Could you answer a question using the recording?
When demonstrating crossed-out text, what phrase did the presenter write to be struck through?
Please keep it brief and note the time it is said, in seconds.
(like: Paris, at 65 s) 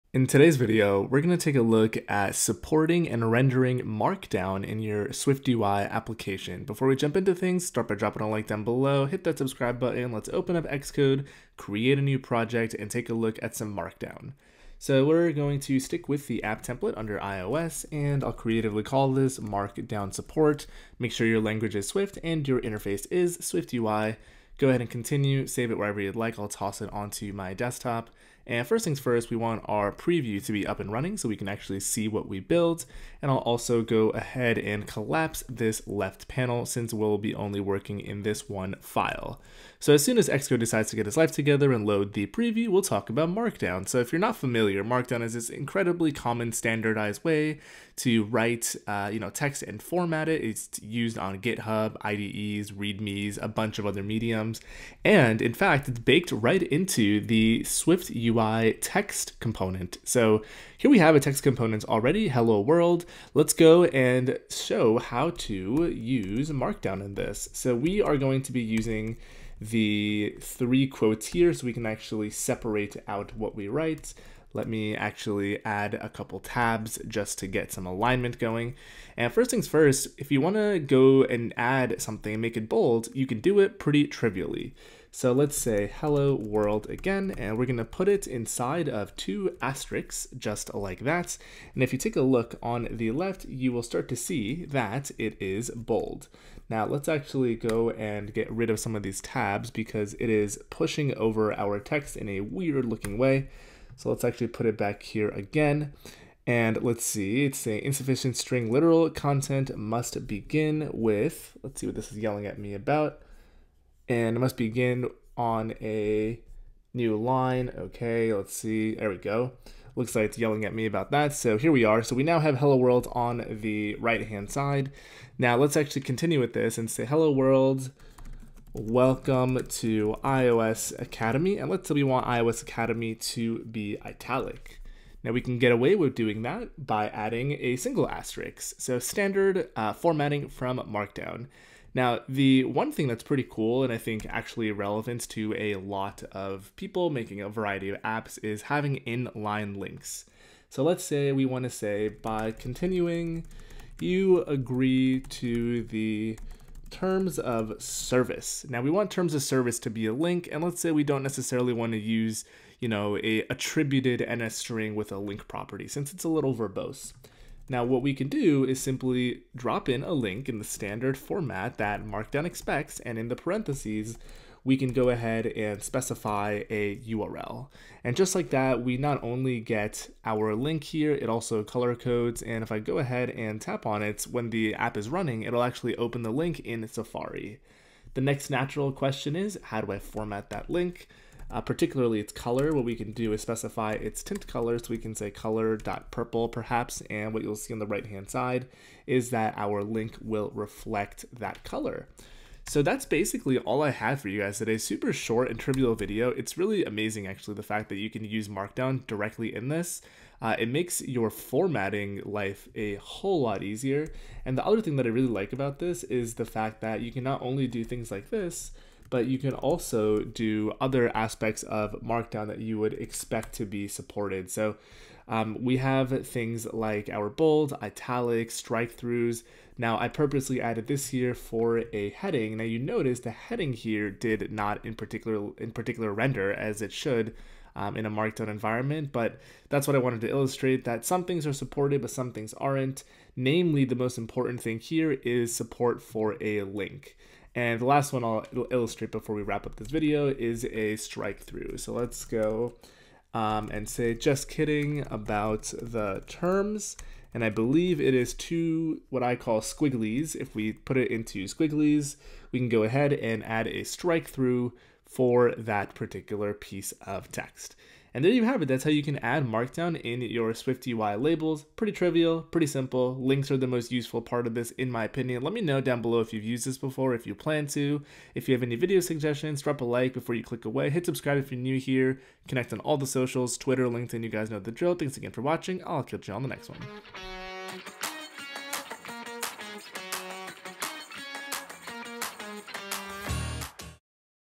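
just kidding about the terms, at 254 s.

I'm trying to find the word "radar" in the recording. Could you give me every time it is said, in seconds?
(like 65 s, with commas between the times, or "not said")
not said.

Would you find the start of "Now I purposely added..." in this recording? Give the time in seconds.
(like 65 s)
229 s.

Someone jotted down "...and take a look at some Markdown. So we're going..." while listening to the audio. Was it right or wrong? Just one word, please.
right.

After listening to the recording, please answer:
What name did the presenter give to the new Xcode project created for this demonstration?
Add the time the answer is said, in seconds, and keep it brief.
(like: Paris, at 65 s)
Markdown Support, at 19 s.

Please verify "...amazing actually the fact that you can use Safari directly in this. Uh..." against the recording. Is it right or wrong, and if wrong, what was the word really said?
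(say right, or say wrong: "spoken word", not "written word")
wrong: "Markdown", not "Safari".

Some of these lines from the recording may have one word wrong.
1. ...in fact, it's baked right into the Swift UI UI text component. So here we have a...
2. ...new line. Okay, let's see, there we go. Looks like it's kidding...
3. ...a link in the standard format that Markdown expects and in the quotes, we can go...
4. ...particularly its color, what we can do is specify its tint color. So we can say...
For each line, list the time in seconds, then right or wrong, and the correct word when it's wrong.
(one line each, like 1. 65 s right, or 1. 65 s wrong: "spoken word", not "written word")
1. 55 s right
2. 116 s wrong: "yelling", not "kidding"
3. 170 s wrong: "parentheses", not "quotes"
4. 191 s right.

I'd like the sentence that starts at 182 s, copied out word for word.
And if I go ahead and tap on it, when the app is running, it'll actually open the link in Safari.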